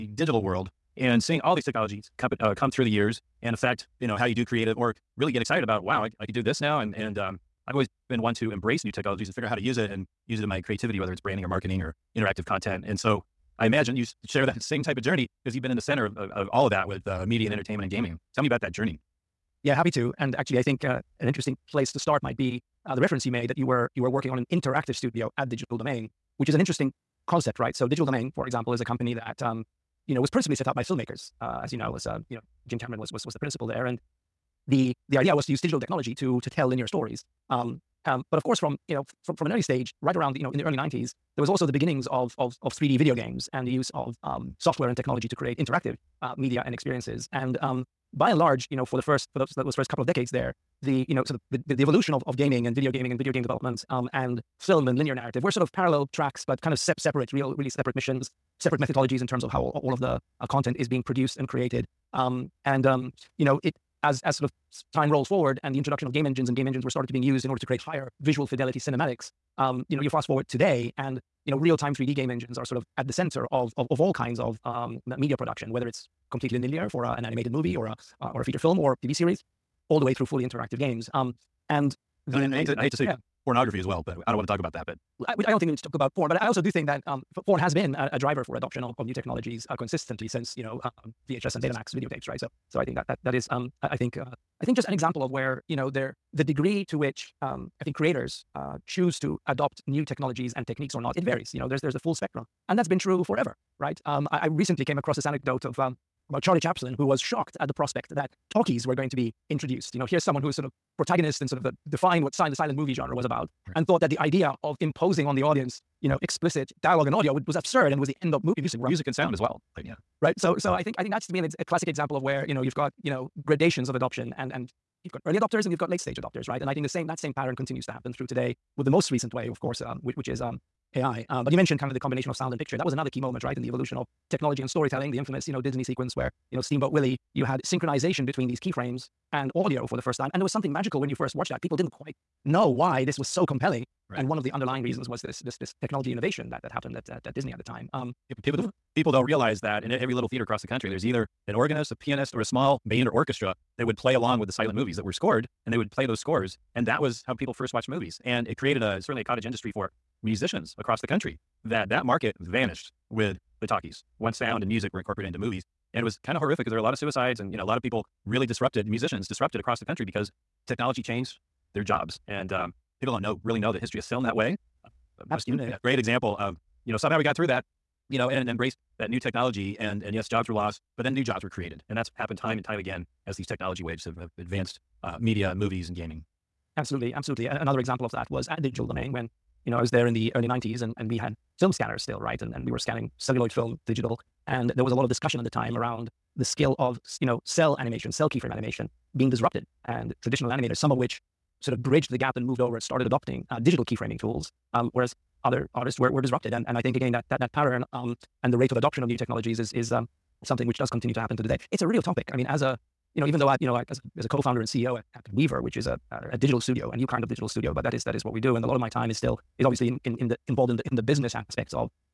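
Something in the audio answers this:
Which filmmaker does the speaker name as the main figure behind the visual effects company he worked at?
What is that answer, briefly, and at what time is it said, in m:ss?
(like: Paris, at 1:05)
Jim Cameron, at 0:32.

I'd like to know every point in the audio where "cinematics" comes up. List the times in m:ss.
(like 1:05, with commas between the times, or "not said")
1:08.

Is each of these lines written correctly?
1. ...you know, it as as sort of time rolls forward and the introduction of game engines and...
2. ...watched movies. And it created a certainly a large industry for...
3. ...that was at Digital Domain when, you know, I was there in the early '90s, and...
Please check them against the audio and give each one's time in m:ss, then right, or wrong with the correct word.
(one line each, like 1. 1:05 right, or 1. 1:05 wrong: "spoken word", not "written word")
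1. 1:03 right
2. 2:37 wrong: "cottage", not "large"
3. 3:08 right.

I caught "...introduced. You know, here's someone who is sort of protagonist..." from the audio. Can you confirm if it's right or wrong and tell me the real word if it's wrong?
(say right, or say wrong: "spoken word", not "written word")
right.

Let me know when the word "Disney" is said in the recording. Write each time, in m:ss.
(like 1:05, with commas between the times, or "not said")
2:15, 2:27.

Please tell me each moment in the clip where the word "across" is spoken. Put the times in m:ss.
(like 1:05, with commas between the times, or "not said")
1:44, 2:30, 2:40, 2:49.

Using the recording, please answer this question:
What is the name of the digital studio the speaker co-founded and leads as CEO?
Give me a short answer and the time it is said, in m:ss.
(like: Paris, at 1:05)
WEVR, at 3:35.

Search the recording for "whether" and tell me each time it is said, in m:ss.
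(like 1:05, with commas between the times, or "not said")
0:10, 1:15.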